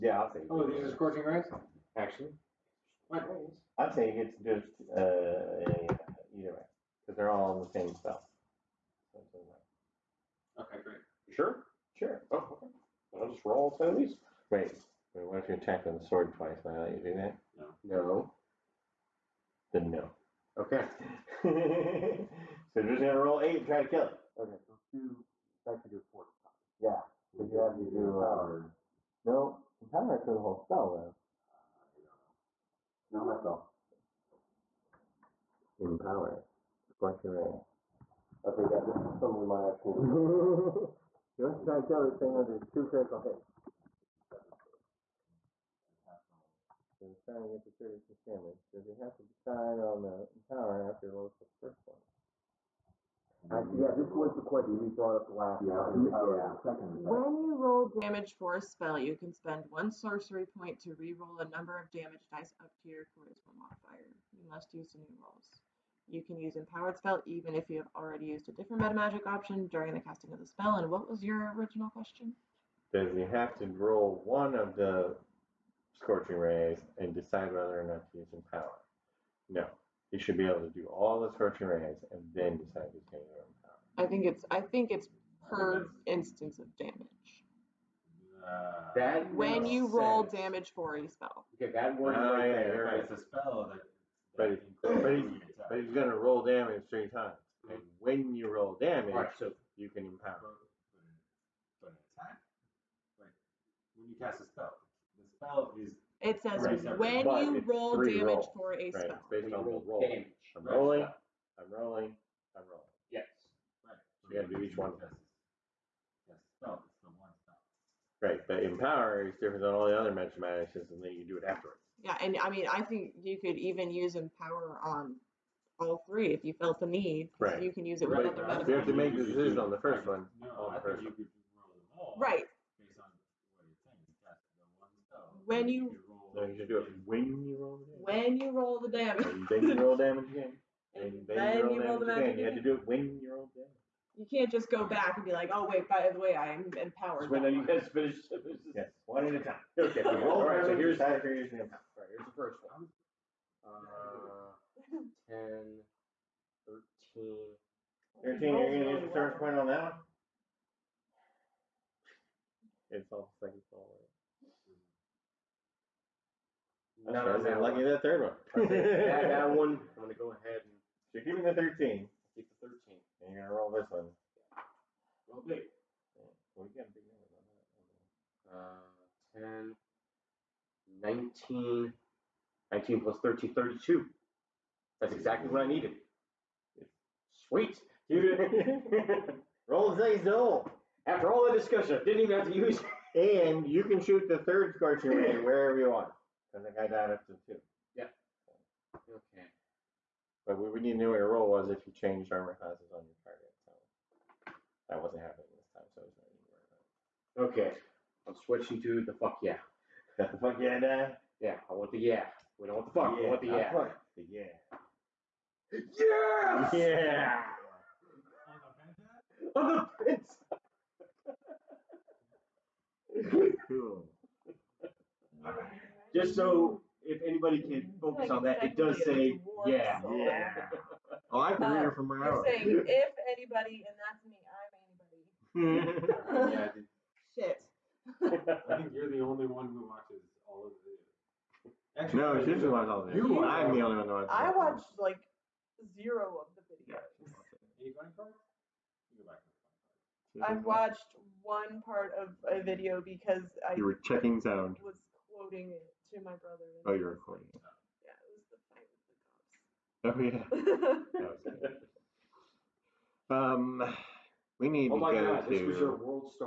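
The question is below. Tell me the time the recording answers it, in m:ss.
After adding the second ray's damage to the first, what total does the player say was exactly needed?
3:03.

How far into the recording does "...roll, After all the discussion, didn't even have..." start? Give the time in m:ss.
3:10.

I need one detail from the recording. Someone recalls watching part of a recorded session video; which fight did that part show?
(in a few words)
the fight with the cops.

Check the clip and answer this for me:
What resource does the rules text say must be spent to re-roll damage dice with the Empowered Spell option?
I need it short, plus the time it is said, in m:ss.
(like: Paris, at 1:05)
one sorcery point, at 0:59.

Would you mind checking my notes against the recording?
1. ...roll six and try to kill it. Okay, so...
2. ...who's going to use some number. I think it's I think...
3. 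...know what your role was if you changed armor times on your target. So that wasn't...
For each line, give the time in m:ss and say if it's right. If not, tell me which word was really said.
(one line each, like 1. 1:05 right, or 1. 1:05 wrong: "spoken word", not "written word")
1. 0:23 wrong: "eight", not "six"
2. 1:22 wrong: "power", not "number"
3. 3:20 wrong: "classes", not "times".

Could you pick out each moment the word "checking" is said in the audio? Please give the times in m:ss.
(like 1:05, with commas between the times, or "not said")
4:14.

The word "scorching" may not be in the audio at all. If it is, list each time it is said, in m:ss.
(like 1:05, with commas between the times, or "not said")
0:00, 0:36, 1:16, 1:21, 3:14.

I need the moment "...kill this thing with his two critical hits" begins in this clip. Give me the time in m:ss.
0:41.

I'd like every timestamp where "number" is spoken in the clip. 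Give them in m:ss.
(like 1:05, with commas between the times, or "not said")
1:01, 2:58.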